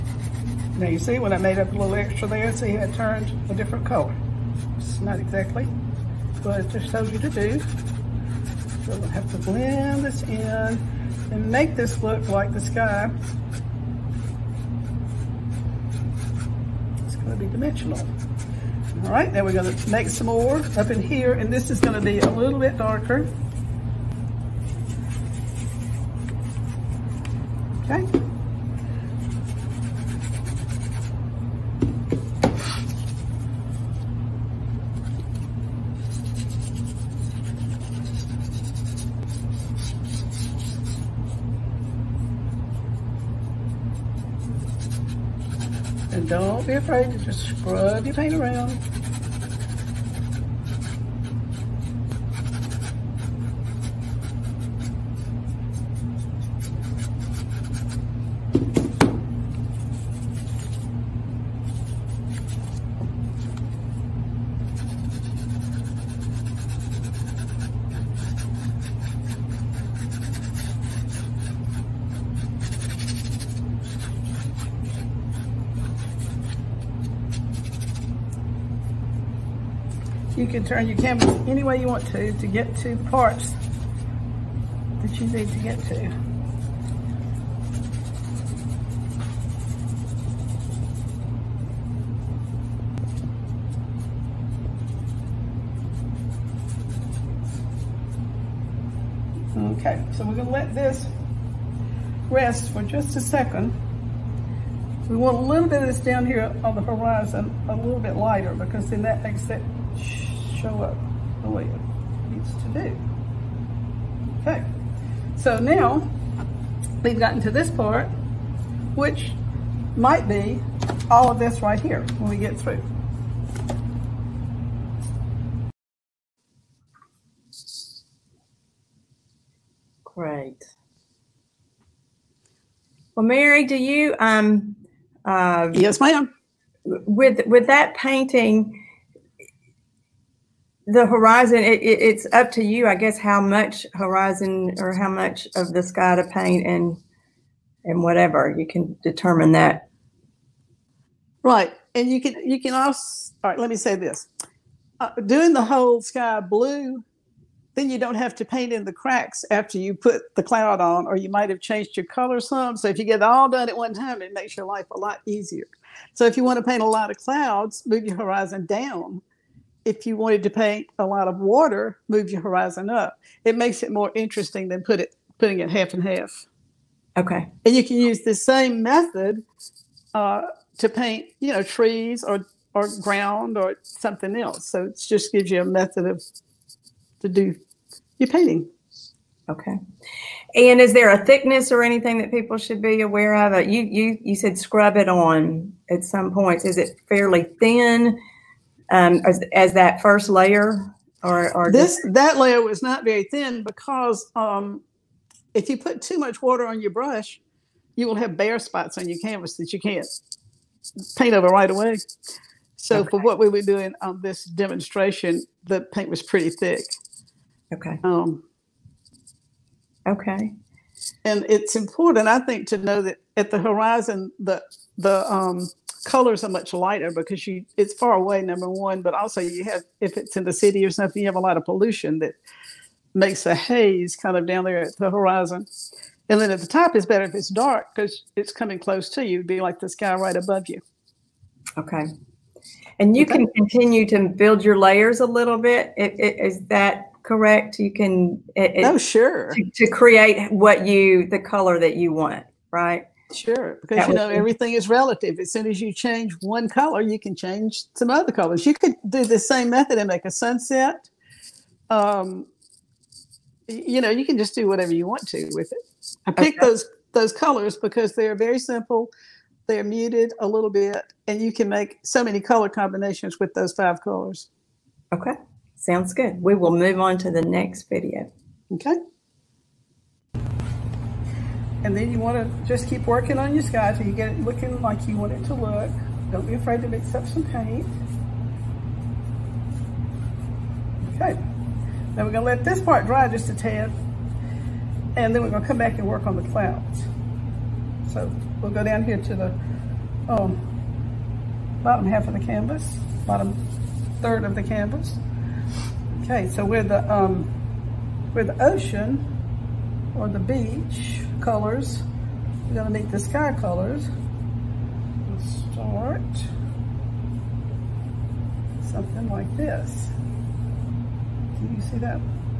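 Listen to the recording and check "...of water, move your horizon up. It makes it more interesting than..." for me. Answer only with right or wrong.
right.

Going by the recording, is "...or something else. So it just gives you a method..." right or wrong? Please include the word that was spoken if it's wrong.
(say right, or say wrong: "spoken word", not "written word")
right.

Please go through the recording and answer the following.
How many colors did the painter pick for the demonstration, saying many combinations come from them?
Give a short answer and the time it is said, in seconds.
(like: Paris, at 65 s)
5, at 273 s.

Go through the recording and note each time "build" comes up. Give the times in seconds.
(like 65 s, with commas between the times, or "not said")
244 s.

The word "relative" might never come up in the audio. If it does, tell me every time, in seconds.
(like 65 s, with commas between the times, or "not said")
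254 s.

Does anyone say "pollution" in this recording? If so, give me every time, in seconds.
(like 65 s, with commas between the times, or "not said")
231 s.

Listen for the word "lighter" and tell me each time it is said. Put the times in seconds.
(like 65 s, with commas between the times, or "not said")
108 s, 226 s.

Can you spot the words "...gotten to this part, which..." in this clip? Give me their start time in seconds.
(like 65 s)
117 s.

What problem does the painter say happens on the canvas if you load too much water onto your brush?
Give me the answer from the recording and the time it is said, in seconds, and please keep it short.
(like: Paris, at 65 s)
Bare spots, at 208 s.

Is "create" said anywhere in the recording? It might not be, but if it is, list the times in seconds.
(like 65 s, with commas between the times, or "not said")
249 s.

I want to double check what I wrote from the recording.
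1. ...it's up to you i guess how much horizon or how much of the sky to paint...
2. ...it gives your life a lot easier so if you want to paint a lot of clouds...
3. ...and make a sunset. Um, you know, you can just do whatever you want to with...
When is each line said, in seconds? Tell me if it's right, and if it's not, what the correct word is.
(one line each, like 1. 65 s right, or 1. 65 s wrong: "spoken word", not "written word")
1. 142 s right
2. 164 s wrong: "makes", not "gives"
3. 259 s right.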